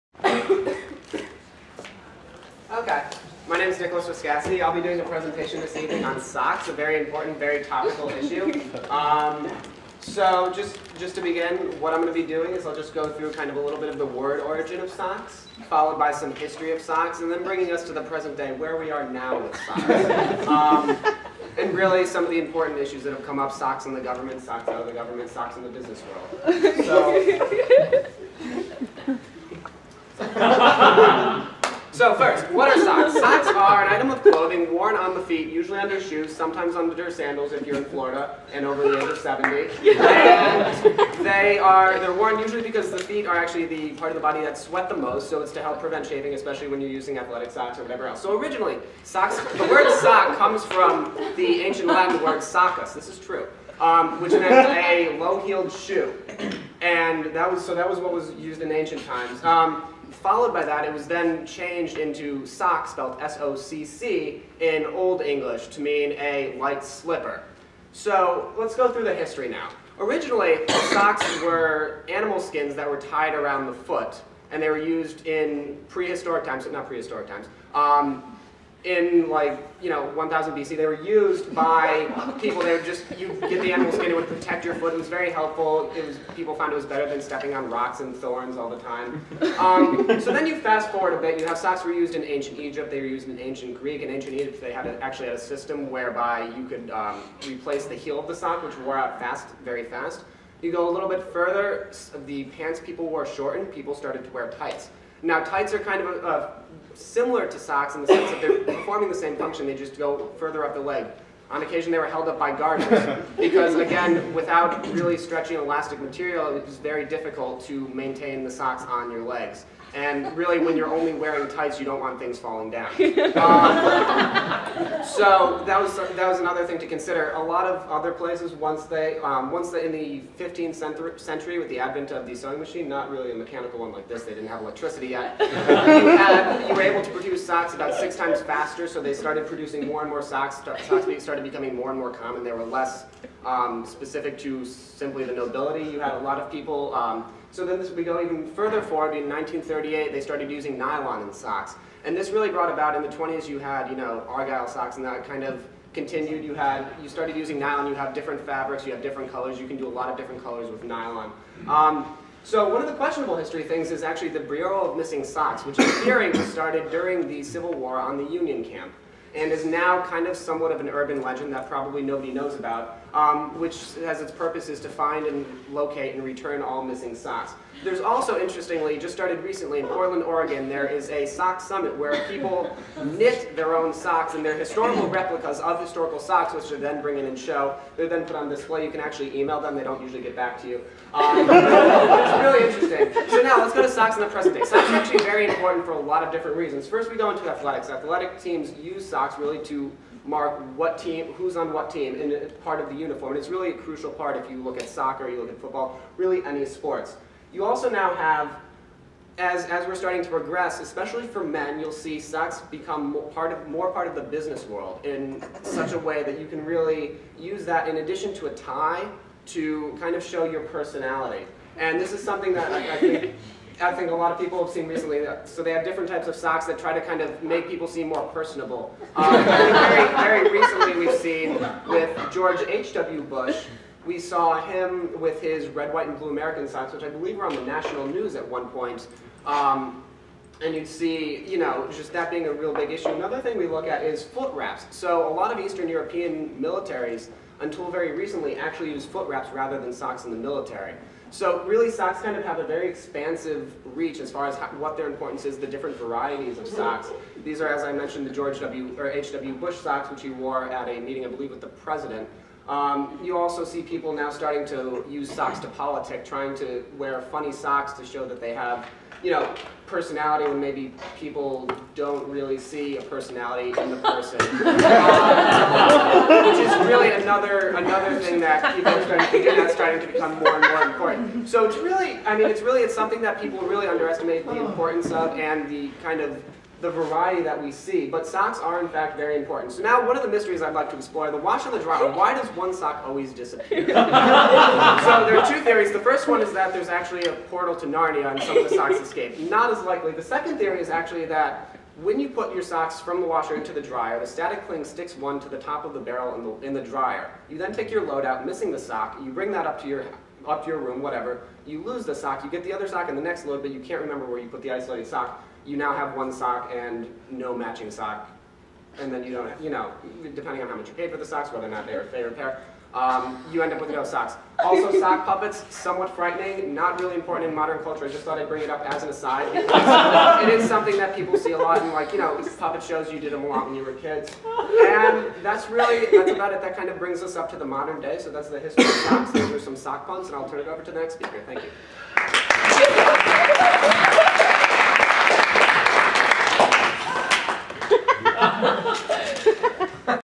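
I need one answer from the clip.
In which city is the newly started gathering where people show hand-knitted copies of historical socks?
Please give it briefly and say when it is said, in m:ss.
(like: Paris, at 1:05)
Portland, Oregon, at 2:59.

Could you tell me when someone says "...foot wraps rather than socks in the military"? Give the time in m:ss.
4:09.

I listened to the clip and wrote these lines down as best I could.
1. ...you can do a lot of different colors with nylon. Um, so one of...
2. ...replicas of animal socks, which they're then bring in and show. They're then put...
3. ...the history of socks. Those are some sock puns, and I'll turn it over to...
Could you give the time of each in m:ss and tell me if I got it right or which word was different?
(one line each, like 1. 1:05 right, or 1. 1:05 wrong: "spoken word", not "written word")
1. 2:39 right
2. 3:05 wrong: "historical", not "animal"
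3. 5:38 right.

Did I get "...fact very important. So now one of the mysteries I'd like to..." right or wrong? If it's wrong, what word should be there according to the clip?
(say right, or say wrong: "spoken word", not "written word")
right.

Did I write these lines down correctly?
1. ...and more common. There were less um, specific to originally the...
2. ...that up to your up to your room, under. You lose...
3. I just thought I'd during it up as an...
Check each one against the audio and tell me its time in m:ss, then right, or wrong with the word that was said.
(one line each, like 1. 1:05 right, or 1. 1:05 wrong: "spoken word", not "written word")
1. 2:21 wrong: "simply", not "originally"
2. 5:09 wrong: "whatever", not "under"
3. 5:28 wrong: "bring", not "during".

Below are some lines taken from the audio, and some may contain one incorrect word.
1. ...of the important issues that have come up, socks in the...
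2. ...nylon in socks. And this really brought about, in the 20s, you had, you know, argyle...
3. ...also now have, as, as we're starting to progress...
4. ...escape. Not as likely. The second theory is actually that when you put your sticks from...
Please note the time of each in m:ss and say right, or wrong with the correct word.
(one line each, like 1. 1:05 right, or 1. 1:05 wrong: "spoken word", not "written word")
1. 0:22 right
2. 2:30 right
3. 3:27 right
4. 4:58 wrong: "socks", not "sticks".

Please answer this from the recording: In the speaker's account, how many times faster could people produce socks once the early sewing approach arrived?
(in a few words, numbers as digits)
6.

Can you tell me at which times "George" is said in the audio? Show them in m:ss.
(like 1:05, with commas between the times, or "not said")
3:52, 4:18.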